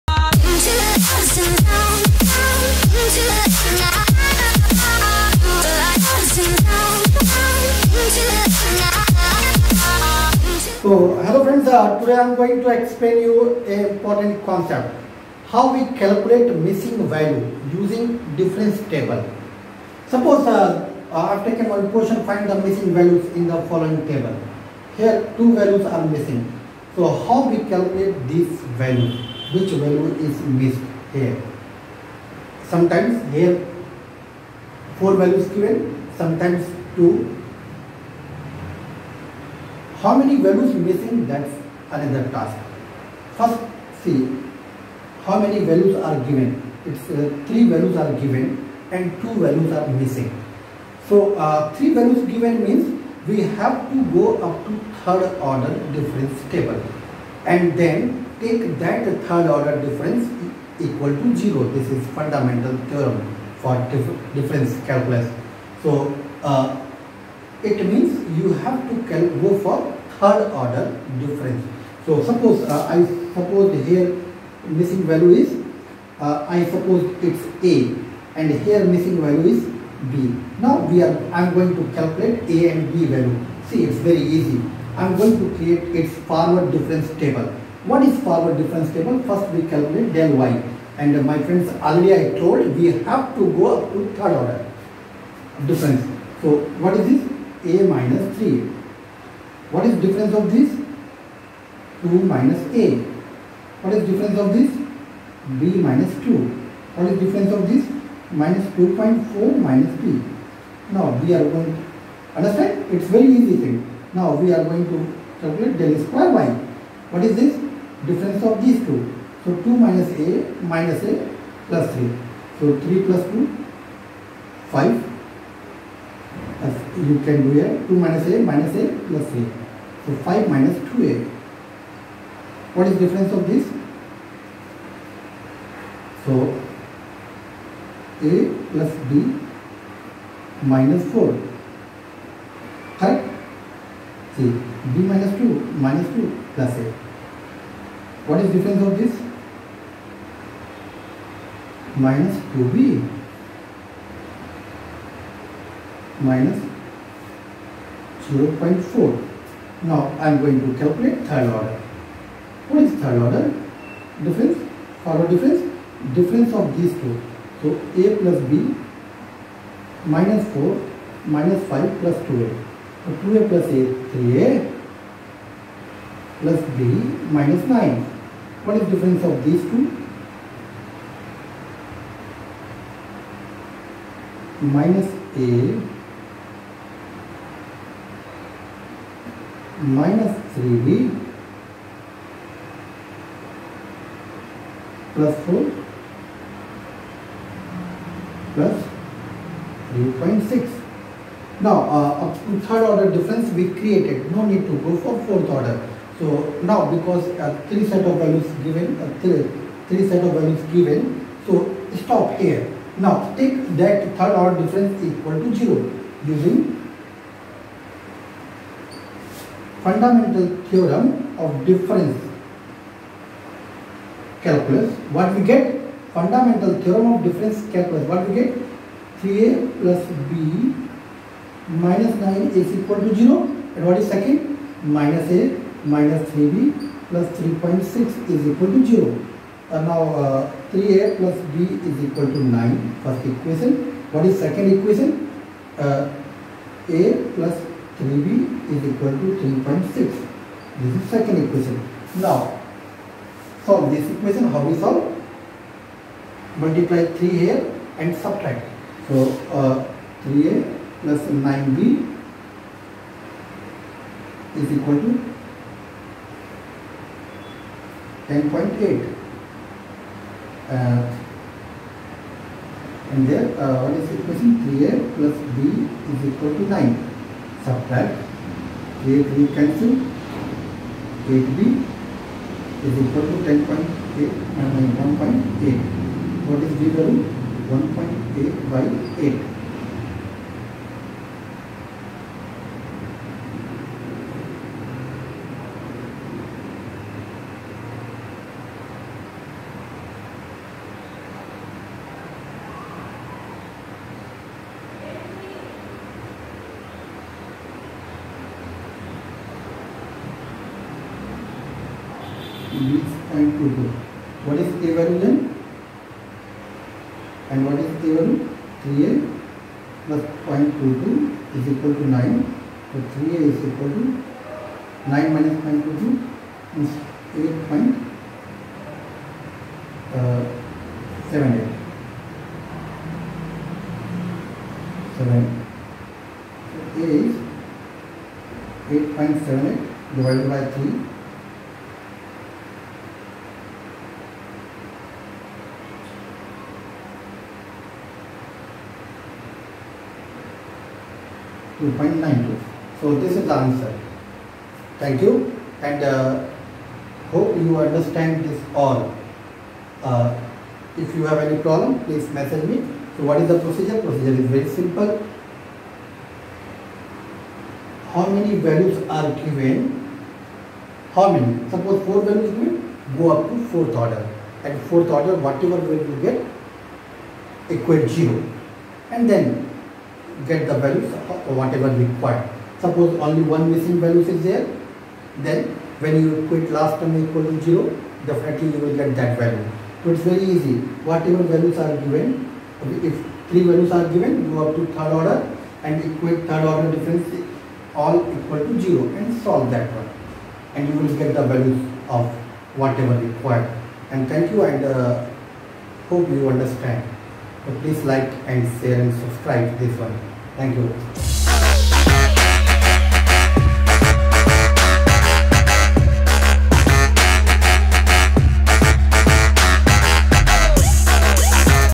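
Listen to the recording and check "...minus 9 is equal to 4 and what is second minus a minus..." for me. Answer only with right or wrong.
wrong.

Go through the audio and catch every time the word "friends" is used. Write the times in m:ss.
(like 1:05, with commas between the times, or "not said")
0:11, 1:31.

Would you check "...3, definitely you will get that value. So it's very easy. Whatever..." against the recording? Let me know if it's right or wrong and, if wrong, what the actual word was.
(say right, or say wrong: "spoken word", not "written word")
wrong: "0", not "3".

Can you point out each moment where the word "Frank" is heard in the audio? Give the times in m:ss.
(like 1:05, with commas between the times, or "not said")
not said.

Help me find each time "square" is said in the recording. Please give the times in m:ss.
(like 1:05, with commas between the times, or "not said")
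1:56.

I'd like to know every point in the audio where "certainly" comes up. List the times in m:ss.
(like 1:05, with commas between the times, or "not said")
not said.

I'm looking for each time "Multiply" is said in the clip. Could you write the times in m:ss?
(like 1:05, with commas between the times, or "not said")
4:16.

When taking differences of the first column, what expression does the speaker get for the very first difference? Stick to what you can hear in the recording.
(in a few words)
a minus 3.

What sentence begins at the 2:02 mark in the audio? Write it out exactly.
So 3 plus 2, 5 you can do here 2 minus a minus a plus a.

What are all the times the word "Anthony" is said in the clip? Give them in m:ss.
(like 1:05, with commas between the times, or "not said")
not said.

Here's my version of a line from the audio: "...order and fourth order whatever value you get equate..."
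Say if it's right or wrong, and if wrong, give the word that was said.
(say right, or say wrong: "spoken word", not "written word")
right.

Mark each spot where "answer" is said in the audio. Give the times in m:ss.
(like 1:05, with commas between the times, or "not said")
5:53.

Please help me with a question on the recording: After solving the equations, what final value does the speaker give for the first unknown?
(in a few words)
2.92.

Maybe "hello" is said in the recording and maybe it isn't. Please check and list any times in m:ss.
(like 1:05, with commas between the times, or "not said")
0:11.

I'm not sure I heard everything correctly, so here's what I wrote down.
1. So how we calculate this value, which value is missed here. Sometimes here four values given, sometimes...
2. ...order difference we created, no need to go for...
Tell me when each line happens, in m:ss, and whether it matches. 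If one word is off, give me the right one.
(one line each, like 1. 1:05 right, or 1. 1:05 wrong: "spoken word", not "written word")
1. 0:26 right
2. 3:22 right.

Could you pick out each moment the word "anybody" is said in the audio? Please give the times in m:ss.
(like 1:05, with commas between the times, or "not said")
not said.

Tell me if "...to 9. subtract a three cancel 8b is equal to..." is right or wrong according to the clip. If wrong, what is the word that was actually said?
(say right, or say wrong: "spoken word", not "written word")
right.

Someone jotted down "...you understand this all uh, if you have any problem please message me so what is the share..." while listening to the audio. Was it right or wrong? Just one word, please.
wrong.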